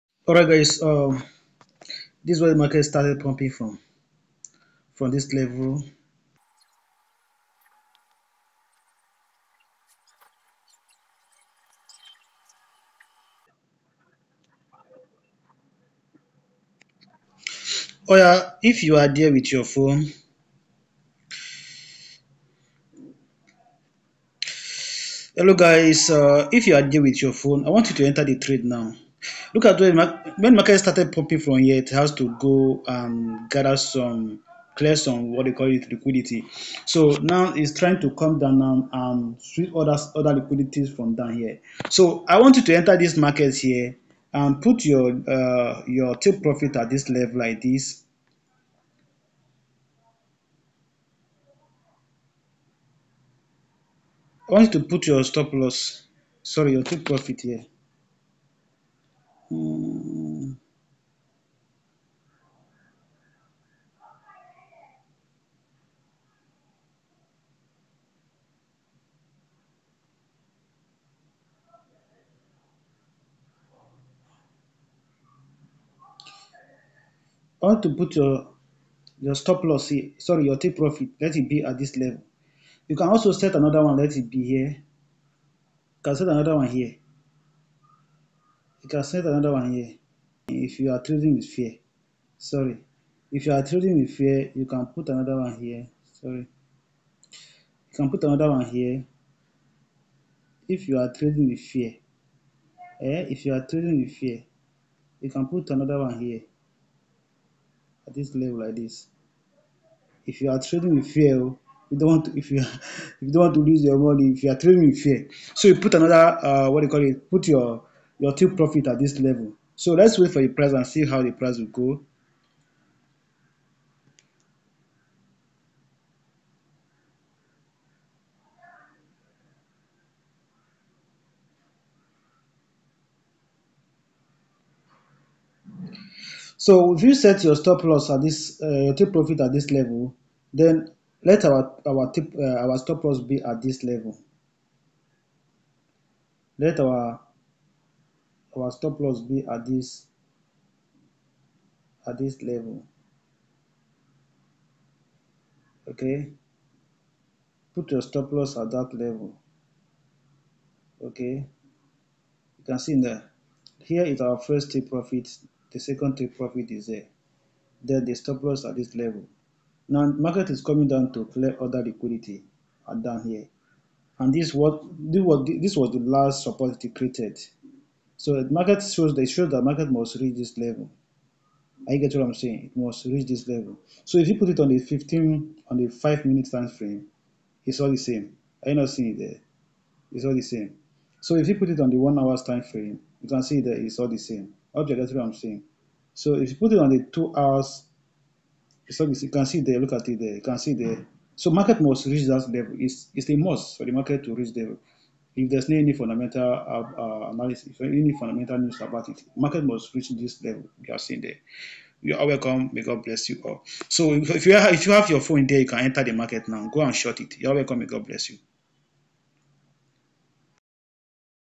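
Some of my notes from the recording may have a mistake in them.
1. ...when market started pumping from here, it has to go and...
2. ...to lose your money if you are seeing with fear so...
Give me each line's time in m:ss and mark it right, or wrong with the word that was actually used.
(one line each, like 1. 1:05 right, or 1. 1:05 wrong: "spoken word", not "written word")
1. 0:30 right
2. 1:53 wrong: "trading", not "seeing".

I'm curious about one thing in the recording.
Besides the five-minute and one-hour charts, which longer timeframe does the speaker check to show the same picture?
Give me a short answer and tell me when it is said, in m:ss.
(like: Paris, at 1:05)
Two hours, at 3:17.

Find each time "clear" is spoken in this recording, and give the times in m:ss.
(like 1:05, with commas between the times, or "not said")
0:34, 2:51.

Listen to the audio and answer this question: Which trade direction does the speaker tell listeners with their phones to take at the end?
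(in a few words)
Short.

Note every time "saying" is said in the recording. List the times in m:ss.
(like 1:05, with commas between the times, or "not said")
3:02, 3:15.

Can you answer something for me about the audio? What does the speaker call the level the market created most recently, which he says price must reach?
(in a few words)
The last support.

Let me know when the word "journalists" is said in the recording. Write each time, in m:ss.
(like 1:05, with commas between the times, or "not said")
not said.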